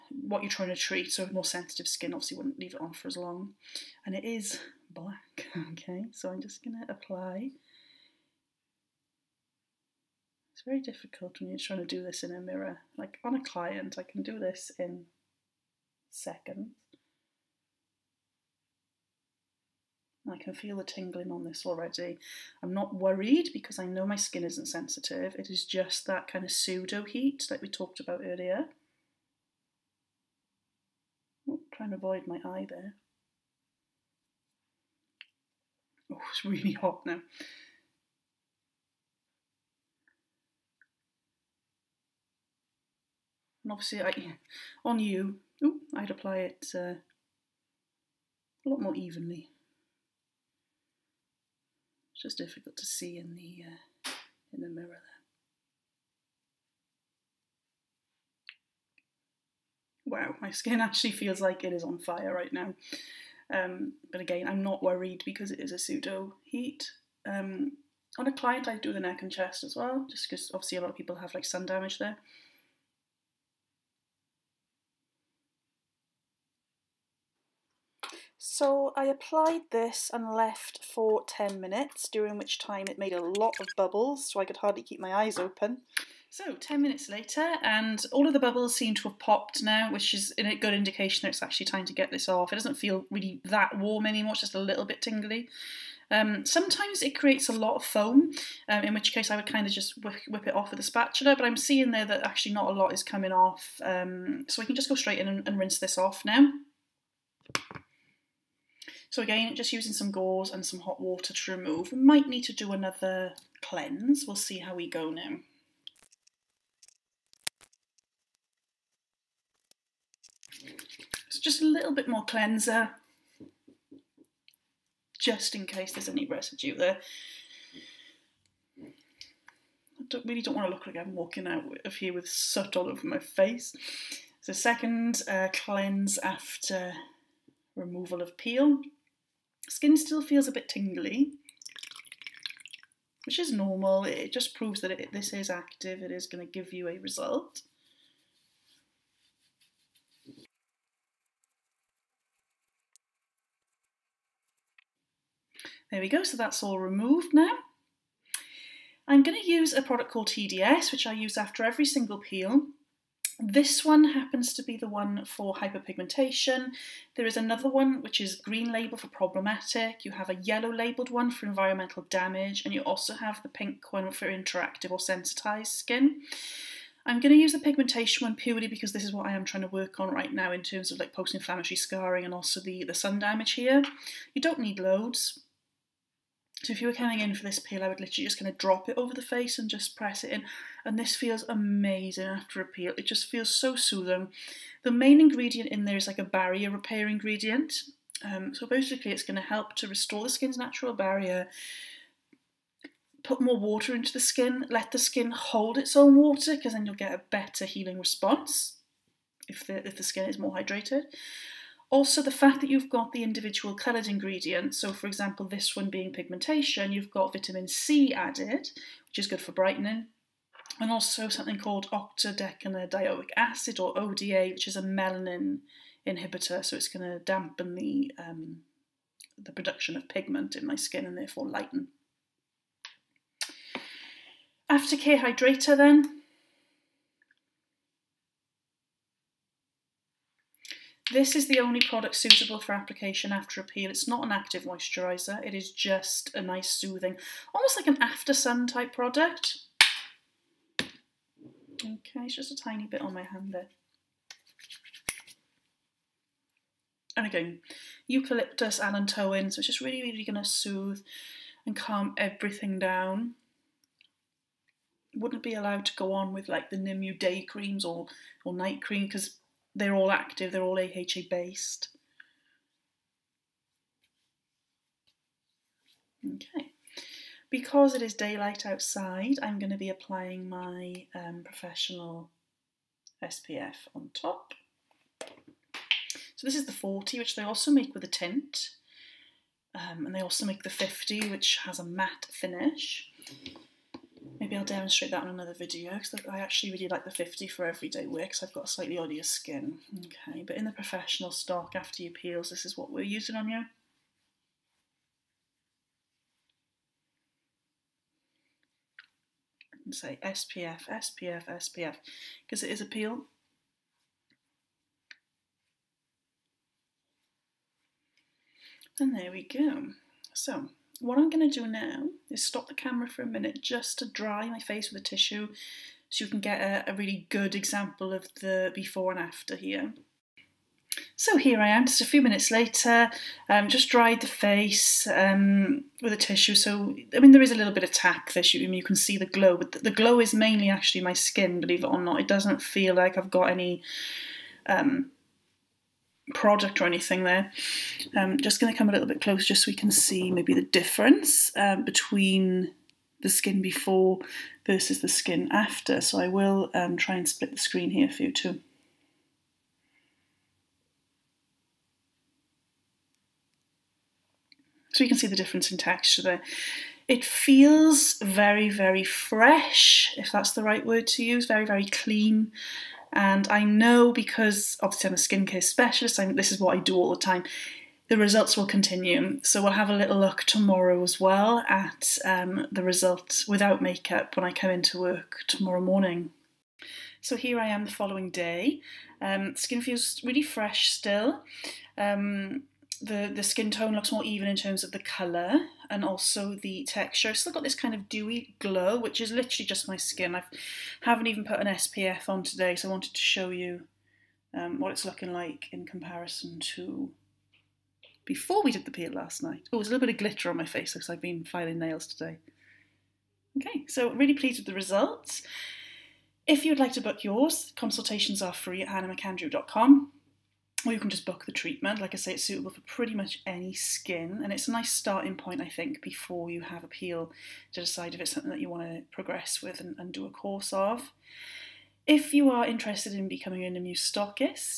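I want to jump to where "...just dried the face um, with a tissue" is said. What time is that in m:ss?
5:33.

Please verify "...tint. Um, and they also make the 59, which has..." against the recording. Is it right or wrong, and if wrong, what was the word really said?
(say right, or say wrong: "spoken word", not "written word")
wrong: "50", not "59".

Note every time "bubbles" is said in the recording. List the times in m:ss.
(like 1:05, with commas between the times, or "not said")
1:23, 1:28.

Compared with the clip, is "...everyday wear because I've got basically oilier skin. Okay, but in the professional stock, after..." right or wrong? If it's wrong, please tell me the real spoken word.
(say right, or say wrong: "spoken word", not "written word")
wrong: "slightly", not "basically".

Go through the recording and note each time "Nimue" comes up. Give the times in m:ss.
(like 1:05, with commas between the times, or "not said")
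4:26, 7:13.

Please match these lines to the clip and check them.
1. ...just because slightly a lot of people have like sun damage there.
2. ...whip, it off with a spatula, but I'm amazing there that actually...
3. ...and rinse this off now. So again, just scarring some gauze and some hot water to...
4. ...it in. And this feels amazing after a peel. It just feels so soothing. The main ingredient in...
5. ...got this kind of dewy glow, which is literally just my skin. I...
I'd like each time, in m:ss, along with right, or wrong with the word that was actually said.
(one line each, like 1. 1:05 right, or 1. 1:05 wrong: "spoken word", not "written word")
1. 1:10 wrong: "obviously", not "slightly"
2. 1:40 wrong: "seeing", not "amazing"
3. 1:45 wrong: "using", not "scarring"
4. 3:10 right
5. 6:37 right.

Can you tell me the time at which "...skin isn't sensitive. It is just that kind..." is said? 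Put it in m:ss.
0:24.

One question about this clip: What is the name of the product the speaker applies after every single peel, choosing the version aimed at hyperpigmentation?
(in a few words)
TDS.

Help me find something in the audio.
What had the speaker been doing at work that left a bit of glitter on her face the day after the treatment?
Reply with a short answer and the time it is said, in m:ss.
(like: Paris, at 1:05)
Filing nails, at 6:51.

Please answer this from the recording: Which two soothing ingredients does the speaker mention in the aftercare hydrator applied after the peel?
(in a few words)
Eucalyptus, allantoin.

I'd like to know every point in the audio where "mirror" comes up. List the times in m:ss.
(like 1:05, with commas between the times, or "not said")
0:12, 0:54.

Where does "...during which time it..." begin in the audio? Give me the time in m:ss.
1:22.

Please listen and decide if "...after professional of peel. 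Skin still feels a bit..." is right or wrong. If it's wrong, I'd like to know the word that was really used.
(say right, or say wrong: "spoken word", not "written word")
wrong: "removal", not "professional".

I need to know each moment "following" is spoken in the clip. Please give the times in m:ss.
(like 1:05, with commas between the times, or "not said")
6:27.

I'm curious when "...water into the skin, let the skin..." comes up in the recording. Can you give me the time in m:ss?
3:23.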